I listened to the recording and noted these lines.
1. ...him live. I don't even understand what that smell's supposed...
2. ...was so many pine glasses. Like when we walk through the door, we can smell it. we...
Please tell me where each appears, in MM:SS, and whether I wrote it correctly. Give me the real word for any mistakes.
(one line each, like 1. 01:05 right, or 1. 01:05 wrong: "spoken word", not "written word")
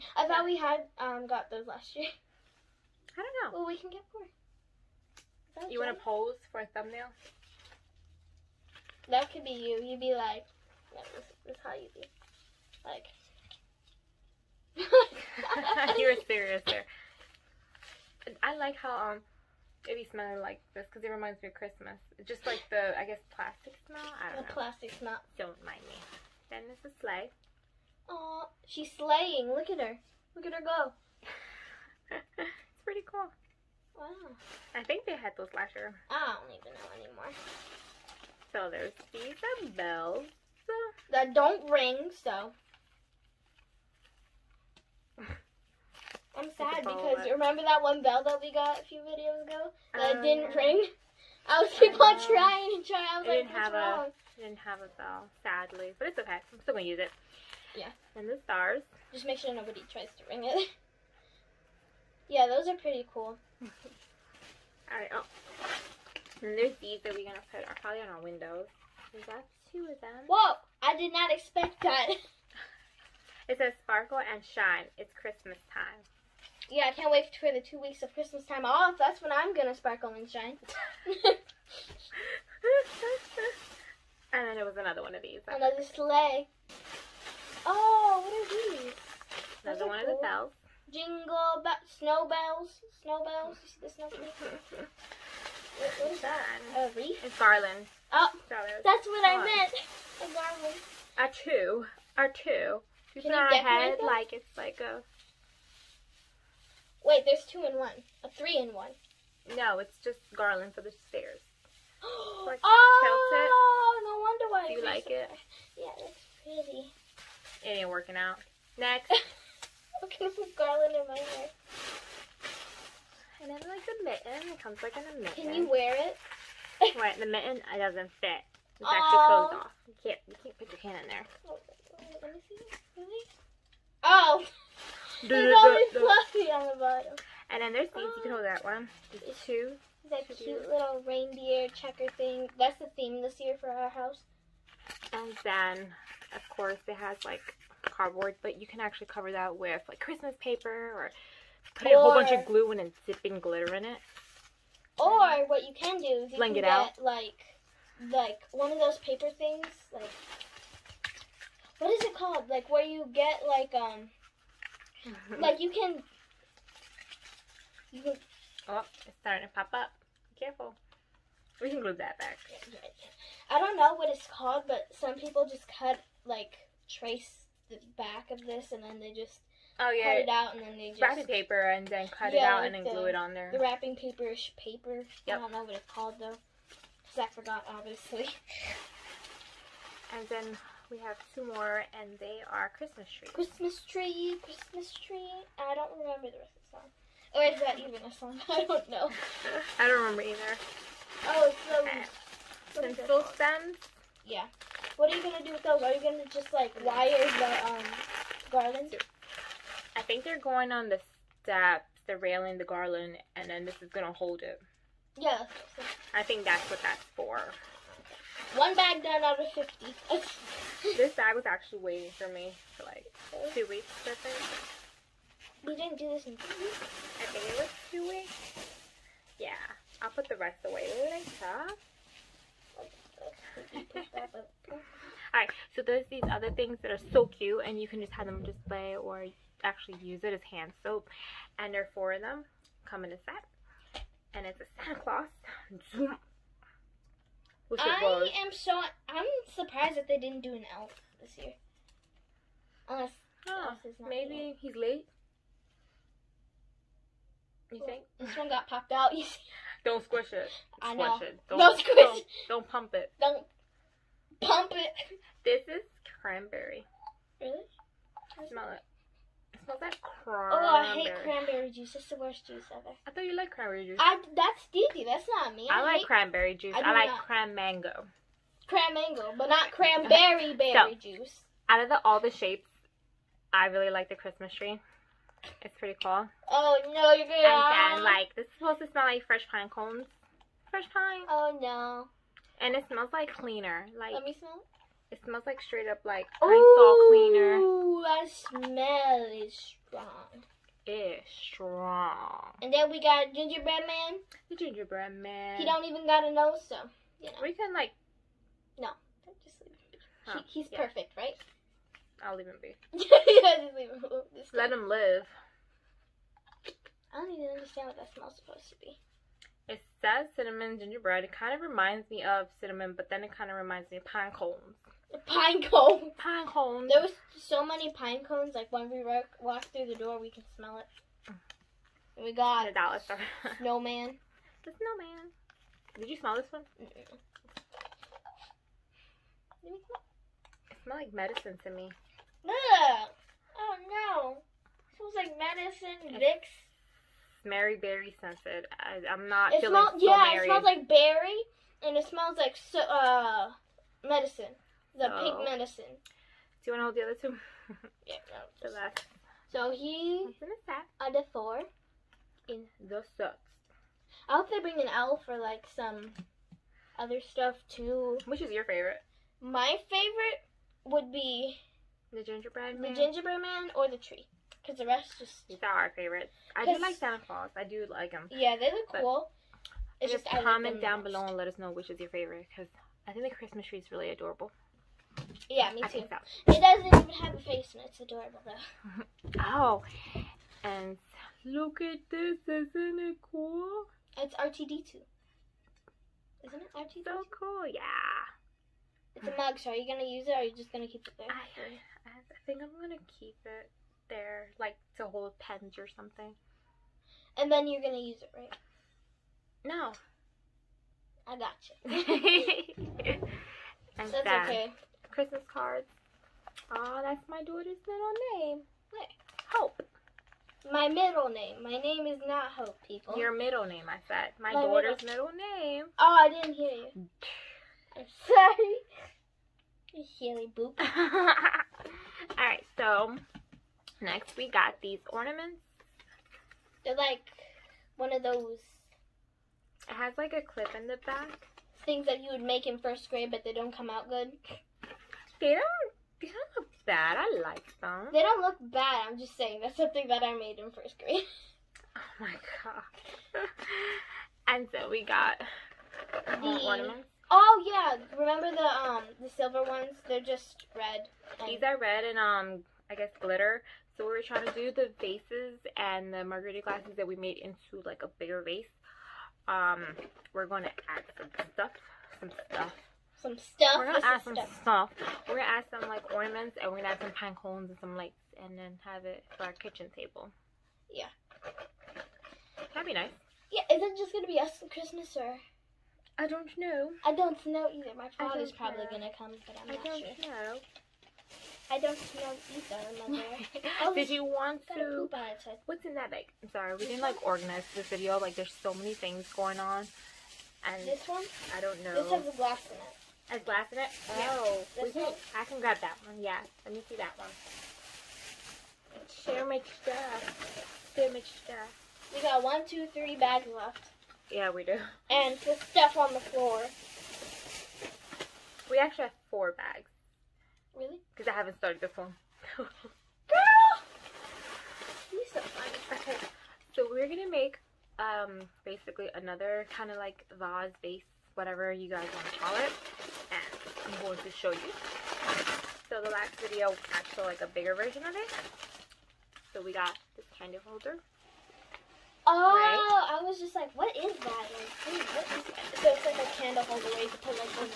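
1. 05:14 right
2. 05:27 wrong: "cones", not "glasses".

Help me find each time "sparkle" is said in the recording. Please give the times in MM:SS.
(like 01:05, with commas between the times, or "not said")
01:13, 01:19.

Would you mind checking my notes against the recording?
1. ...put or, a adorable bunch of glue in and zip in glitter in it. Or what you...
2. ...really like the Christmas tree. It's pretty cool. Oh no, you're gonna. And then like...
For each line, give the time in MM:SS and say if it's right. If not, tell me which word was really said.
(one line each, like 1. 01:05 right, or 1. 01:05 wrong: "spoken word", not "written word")
1. 02:31 wrong: "whole", not "adorable"
2. 04:43 right.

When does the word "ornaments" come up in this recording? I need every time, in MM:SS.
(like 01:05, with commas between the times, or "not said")
07:15, 07:36, 07:56.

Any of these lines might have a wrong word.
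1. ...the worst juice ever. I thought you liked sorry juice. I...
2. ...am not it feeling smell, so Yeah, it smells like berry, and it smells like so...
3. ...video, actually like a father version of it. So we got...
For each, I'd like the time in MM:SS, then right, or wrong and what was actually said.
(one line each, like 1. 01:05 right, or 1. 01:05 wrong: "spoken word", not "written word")
1. 04:32 wrong: "cranberry", not "sorry"
2. 05:49 right
3. 08:56 wrong: "bigger", not "father".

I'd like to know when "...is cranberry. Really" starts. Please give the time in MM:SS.
04:25.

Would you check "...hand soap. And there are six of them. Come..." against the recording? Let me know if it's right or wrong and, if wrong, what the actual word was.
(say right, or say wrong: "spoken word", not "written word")
wrong: "four", not "six".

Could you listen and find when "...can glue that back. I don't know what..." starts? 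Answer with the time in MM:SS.
02:51.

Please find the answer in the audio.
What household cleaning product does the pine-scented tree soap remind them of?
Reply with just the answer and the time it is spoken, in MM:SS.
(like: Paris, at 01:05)
Lysol, at 04:56.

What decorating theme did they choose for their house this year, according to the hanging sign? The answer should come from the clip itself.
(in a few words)
Reindeer checker.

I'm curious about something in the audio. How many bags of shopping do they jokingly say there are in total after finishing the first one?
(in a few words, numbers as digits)
50.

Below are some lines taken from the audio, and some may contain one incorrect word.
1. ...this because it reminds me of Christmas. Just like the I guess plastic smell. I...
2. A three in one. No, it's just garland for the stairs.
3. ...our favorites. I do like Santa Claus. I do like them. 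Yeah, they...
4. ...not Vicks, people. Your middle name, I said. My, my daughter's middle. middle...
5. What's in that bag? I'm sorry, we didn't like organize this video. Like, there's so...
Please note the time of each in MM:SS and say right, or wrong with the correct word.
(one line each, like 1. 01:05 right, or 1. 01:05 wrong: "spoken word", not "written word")
1. 00:20 right
2. 01:48 right
3. 06:15 right
4. 07:02 wrong: "Hope", not "Vicks"
5. 08:15 right.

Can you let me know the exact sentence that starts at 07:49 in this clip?
Um, we're going to add some stuff, some stuff.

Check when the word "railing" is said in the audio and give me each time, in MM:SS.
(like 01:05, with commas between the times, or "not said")
03:32.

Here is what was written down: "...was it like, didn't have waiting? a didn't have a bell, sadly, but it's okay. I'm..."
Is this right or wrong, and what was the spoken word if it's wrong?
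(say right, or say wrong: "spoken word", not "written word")
wrong: "wrong", not "waiting".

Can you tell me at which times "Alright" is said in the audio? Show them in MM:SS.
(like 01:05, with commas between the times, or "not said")
01:04, 03:55.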